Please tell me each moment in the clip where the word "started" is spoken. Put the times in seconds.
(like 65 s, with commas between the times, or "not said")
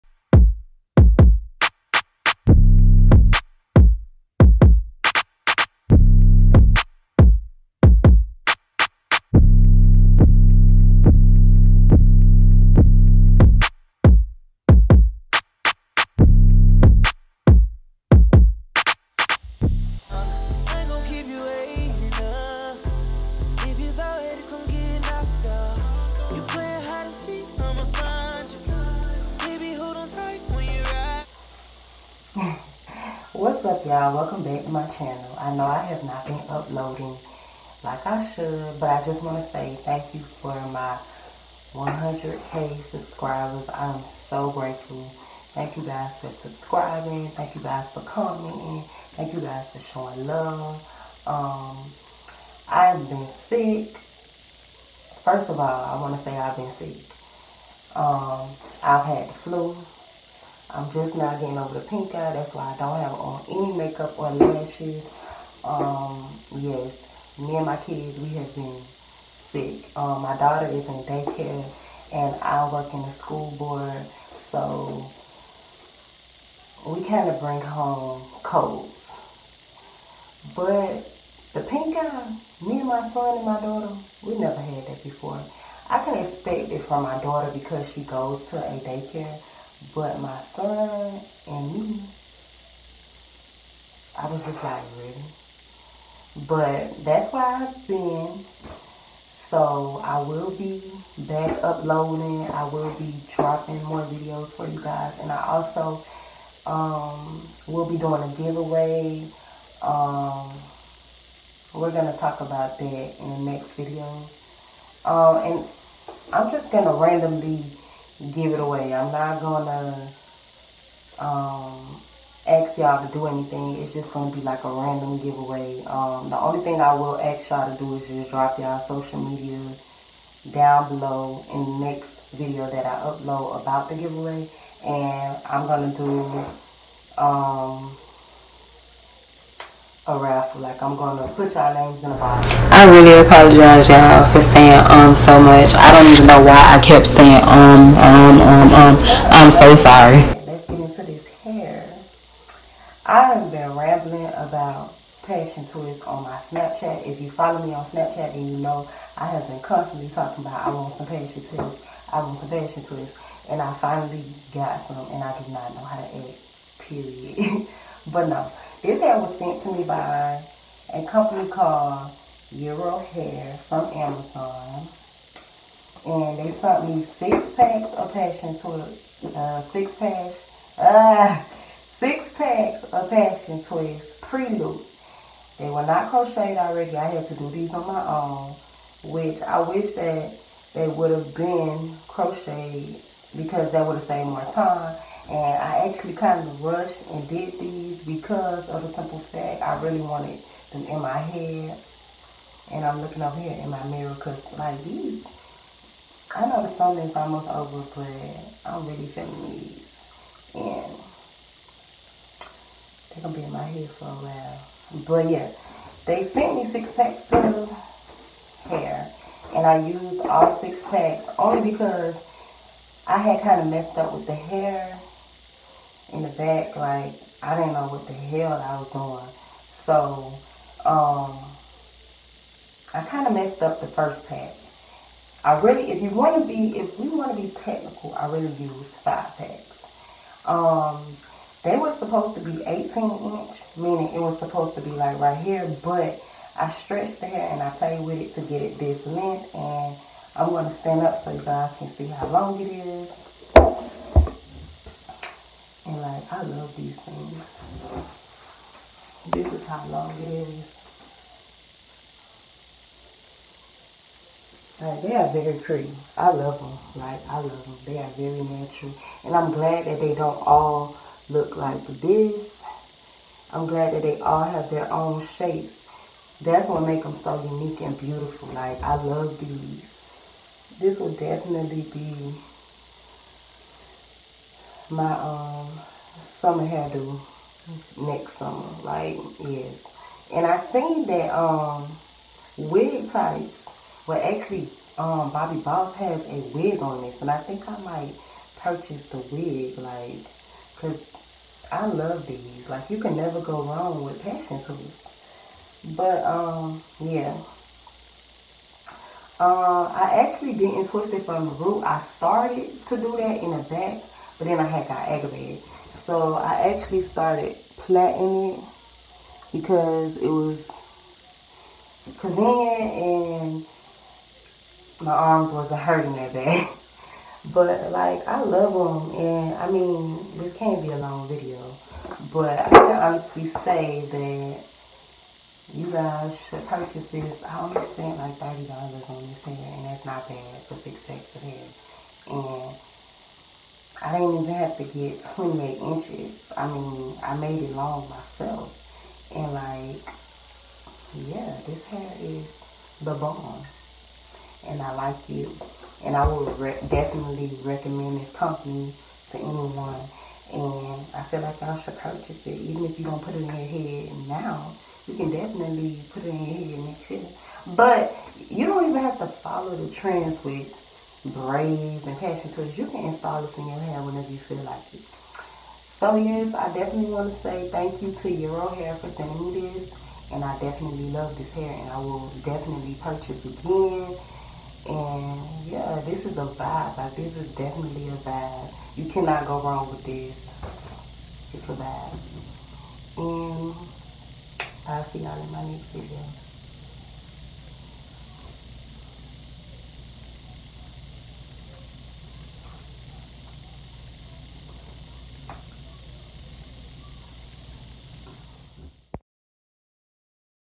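312 s, 317 s.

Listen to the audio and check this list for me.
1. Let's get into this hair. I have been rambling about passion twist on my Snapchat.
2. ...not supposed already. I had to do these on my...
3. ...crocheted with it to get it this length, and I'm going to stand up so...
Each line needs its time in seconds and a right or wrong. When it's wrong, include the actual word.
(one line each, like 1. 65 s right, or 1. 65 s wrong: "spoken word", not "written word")
1. 150 s right
2. 185 s wrong: "crocheted", not "supposed"
3. 247 s wrong: "played", not "crocheted".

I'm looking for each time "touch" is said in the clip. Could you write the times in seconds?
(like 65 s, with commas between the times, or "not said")
not said.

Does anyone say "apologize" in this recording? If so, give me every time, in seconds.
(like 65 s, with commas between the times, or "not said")
143 s.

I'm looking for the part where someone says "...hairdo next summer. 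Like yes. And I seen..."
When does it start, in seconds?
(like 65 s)
286 s.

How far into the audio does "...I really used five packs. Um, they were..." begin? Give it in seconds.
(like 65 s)
238 s.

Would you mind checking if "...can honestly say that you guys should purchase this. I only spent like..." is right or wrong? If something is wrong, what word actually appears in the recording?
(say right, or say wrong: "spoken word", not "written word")
right.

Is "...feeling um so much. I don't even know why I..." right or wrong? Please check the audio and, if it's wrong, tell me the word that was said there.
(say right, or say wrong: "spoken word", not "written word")
wrong: "saying", not "feeling".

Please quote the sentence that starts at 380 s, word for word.
And I definitely love this hair and I will definitely purchase again.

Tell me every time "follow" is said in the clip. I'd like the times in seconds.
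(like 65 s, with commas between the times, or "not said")
157 s, 369 s.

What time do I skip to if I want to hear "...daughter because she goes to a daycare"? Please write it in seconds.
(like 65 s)
87 s.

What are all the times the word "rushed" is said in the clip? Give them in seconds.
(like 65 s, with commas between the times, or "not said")
196 s.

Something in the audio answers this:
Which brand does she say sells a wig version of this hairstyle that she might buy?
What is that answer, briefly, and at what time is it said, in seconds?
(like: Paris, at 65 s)
Bobbi Boss, at 295 s.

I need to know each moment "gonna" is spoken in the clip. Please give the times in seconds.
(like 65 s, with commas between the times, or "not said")
119 s, 124 s, 135 s, 140 s.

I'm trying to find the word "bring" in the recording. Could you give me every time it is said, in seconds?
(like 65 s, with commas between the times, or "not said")
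77 s.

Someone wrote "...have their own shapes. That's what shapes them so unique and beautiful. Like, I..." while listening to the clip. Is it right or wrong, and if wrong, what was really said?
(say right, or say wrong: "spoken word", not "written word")
wrong: "makes", not "shapes".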